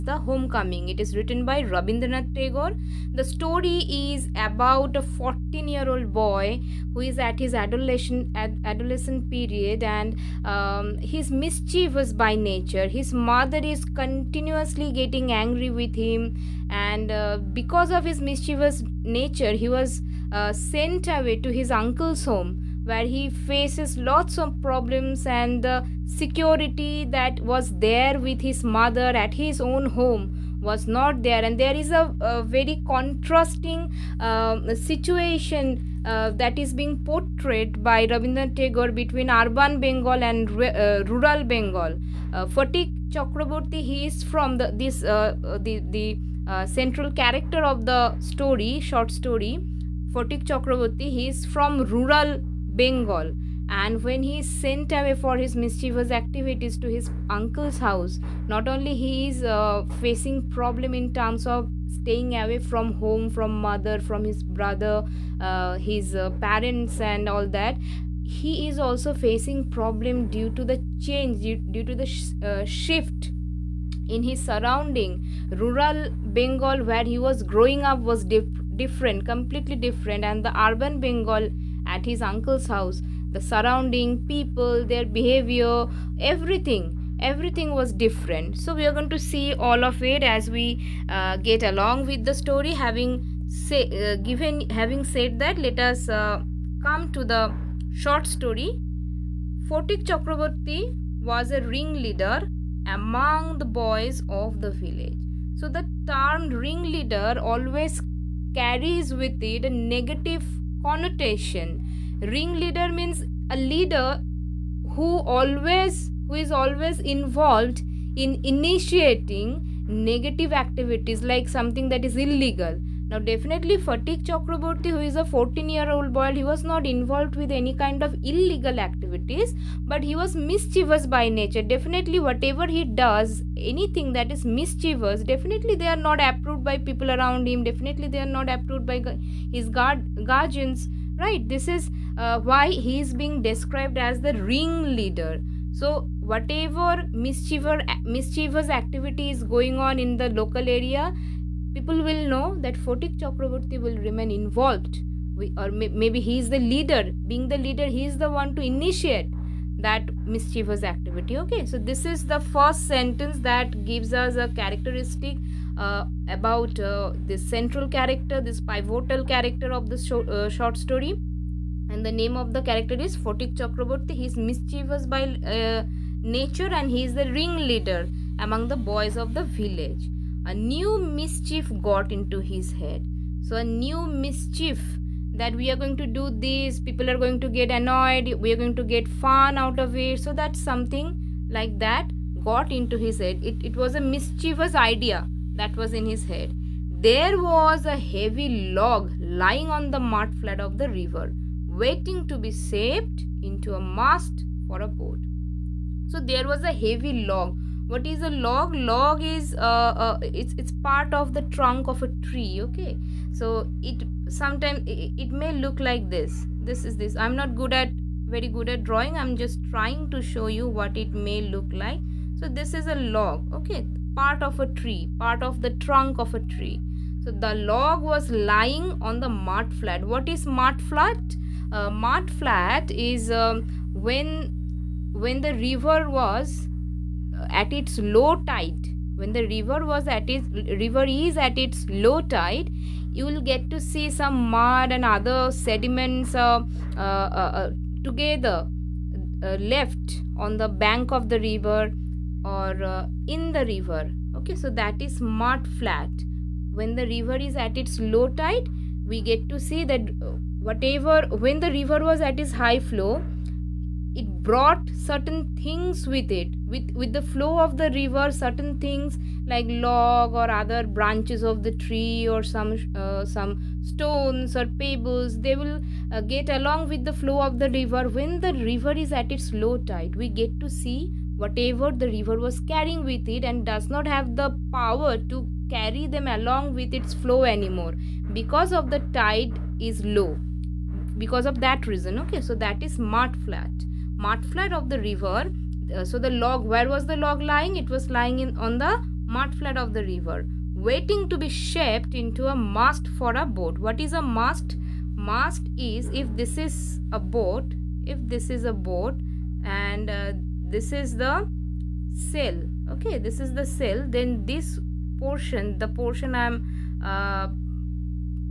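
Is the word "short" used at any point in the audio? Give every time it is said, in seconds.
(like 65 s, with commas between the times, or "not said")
48 s, 97 s, 170 s.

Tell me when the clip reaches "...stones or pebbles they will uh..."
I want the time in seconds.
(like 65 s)
273 s.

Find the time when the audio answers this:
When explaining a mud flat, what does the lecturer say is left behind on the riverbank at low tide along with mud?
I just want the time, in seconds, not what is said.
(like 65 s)
245 s.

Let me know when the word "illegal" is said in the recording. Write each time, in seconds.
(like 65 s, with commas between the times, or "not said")
122 s, 128 s.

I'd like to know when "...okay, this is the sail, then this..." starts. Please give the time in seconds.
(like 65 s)
312 s.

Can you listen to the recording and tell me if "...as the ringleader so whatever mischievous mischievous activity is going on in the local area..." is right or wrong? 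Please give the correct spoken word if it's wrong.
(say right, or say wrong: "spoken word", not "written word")
right.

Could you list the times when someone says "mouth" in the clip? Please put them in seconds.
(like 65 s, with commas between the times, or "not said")
not said.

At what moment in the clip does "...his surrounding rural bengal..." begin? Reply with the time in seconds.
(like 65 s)
74 s.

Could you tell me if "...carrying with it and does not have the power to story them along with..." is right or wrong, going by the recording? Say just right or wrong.
wrong.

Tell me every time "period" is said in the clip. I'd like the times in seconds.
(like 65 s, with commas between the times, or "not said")
9 s.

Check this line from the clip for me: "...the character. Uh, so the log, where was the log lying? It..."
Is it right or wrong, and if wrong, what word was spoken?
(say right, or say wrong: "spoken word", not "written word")
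wrong: "river", not "character".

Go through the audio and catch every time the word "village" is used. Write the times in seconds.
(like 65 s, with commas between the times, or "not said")
104 s, 179 s.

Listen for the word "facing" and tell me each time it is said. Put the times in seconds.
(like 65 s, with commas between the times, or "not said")
59 s, 69 s.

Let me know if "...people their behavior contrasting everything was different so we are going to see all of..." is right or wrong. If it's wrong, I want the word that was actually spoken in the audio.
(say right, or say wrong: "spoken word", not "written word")
wrong: "everything", not "contrasting".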